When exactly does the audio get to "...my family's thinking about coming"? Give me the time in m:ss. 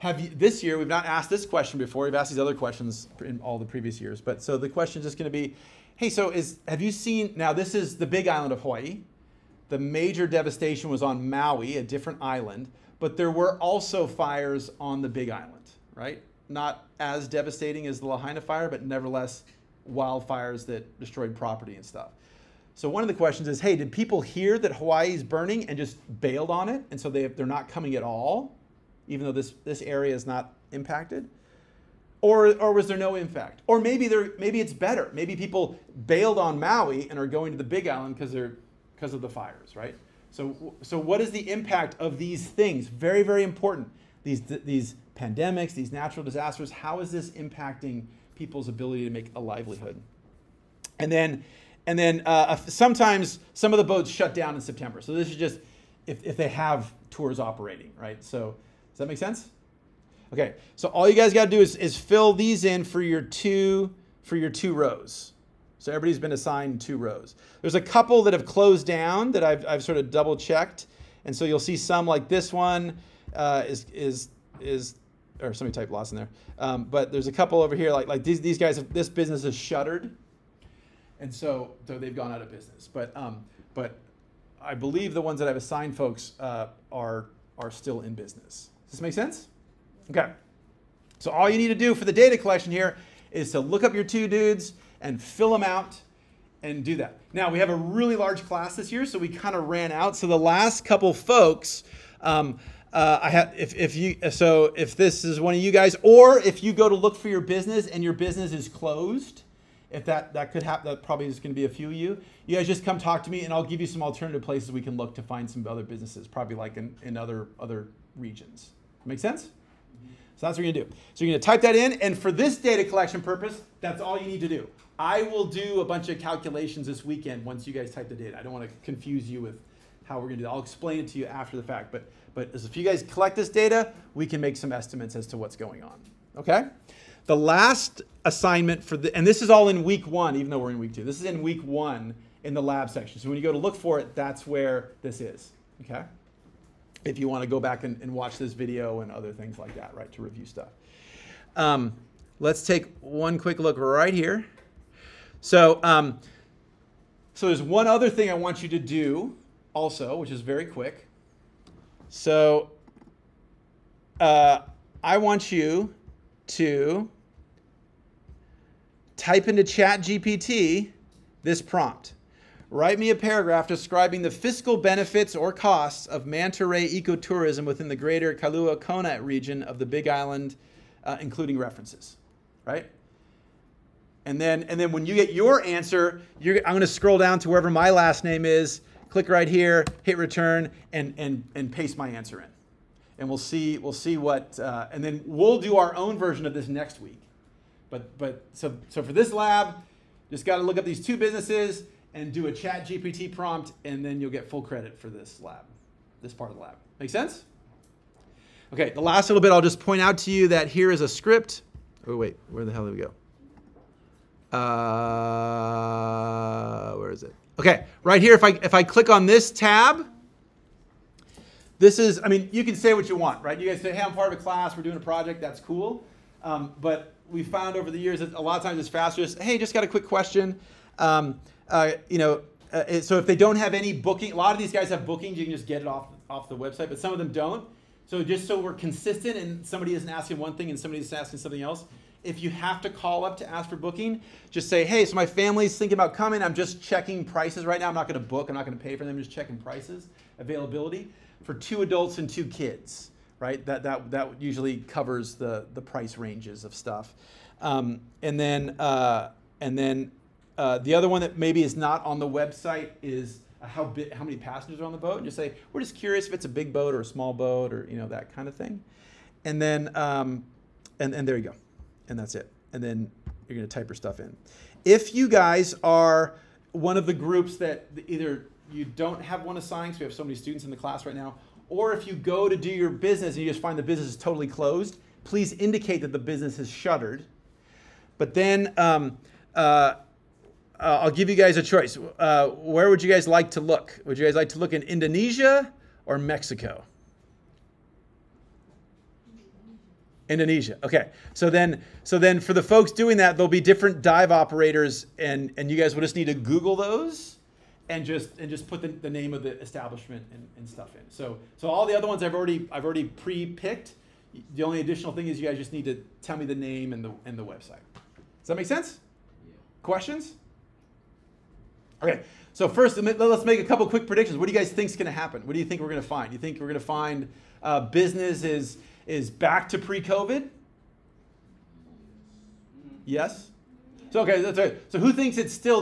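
4:05.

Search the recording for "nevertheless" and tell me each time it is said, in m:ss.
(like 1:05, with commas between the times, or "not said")
0:18.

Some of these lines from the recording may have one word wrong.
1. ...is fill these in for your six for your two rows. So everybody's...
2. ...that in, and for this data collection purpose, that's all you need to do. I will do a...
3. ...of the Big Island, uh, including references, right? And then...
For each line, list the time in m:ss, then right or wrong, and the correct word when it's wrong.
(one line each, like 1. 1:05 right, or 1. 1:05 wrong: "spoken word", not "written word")
1. 1:01 wrong: "two", not "six"
2. 2:01 right
3. 2:59 right.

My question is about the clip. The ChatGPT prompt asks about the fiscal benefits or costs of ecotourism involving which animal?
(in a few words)
manta ray.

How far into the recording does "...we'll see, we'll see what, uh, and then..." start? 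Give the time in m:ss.
3:13.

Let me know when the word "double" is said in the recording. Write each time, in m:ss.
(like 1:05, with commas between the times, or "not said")
1:10.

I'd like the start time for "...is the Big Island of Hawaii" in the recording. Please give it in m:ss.
0:07.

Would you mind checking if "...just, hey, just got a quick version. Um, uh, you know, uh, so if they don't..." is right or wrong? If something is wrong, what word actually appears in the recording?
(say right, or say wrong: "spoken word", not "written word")
wrong: "question", not "version".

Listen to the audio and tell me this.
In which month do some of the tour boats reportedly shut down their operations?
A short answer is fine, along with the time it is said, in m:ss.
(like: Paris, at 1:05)
September, at 0:54.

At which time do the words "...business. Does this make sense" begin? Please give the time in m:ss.
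1:28.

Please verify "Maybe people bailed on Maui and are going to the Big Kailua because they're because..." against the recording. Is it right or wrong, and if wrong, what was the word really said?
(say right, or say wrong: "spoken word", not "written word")
wrong: "Island", not "Kailua".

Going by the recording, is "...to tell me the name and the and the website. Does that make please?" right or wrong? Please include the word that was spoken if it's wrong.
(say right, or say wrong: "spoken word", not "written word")
wrong: "sense", not "please".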